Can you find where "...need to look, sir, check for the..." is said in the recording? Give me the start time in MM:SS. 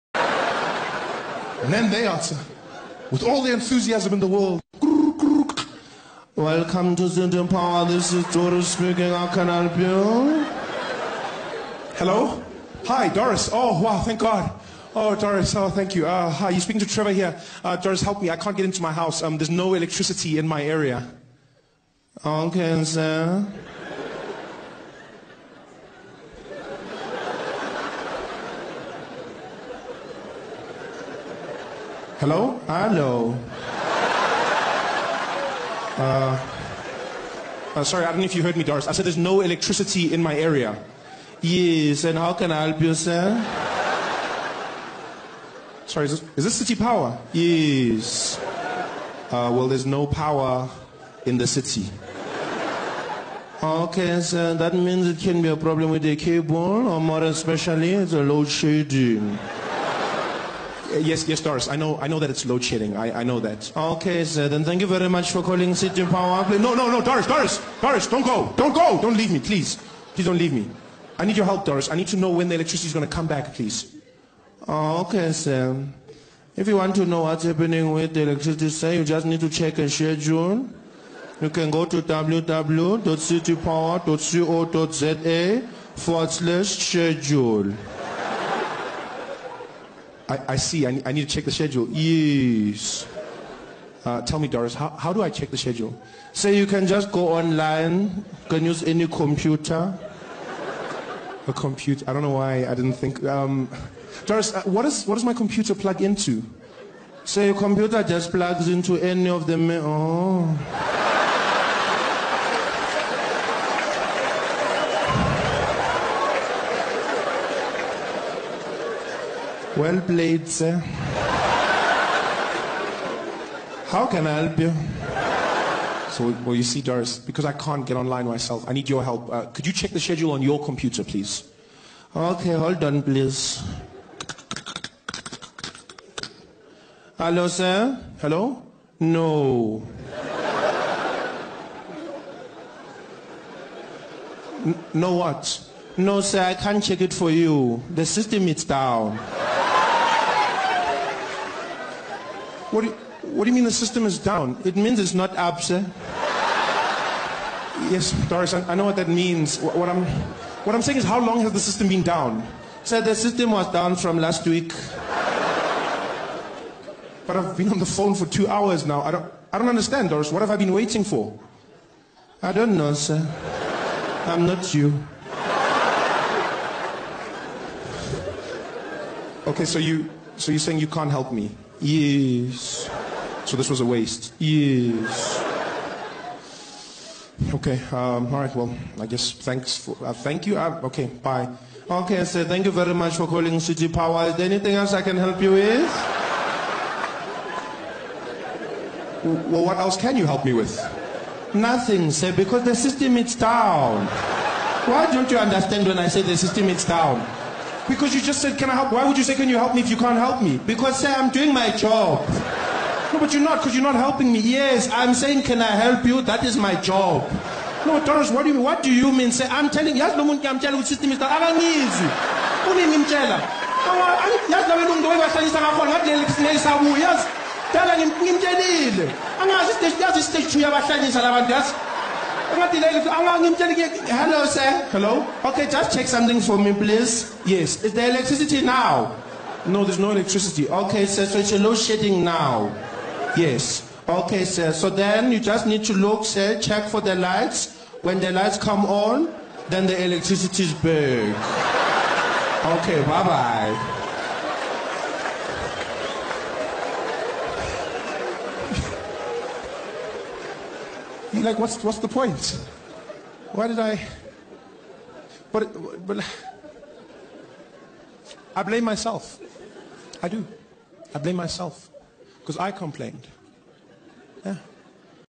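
04:05.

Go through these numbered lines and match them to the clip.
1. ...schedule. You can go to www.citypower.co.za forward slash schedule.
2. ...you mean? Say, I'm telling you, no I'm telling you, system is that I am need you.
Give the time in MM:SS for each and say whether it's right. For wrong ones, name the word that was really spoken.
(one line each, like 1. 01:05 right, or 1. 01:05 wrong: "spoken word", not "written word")
1. 01:19 right
2. 03:38 right.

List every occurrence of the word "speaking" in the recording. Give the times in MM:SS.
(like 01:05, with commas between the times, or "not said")
00:08, 00:16.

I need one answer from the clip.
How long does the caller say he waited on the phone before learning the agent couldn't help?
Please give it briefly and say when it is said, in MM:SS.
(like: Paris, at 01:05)
two hours, at 02:48.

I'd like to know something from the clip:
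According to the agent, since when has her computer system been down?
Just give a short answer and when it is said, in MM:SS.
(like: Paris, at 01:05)
last week, at 02:44.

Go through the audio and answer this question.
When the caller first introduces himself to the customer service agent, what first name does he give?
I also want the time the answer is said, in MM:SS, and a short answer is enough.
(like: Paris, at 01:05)
Trevor, at 00:16.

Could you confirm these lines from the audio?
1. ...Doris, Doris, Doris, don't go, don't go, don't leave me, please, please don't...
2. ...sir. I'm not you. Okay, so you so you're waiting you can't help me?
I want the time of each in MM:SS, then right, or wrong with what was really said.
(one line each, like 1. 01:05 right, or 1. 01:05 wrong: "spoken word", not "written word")
1. 01:06 right
2. 02:52 wrong: "saying", not "waiting".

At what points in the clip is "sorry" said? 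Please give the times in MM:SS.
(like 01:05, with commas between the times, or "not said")
00:37, 00:45.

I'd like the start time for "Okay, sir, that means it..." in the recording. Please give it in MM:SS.
00:53.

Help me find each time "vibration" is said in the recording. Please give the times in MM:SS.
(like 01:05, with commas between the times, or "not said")
not said.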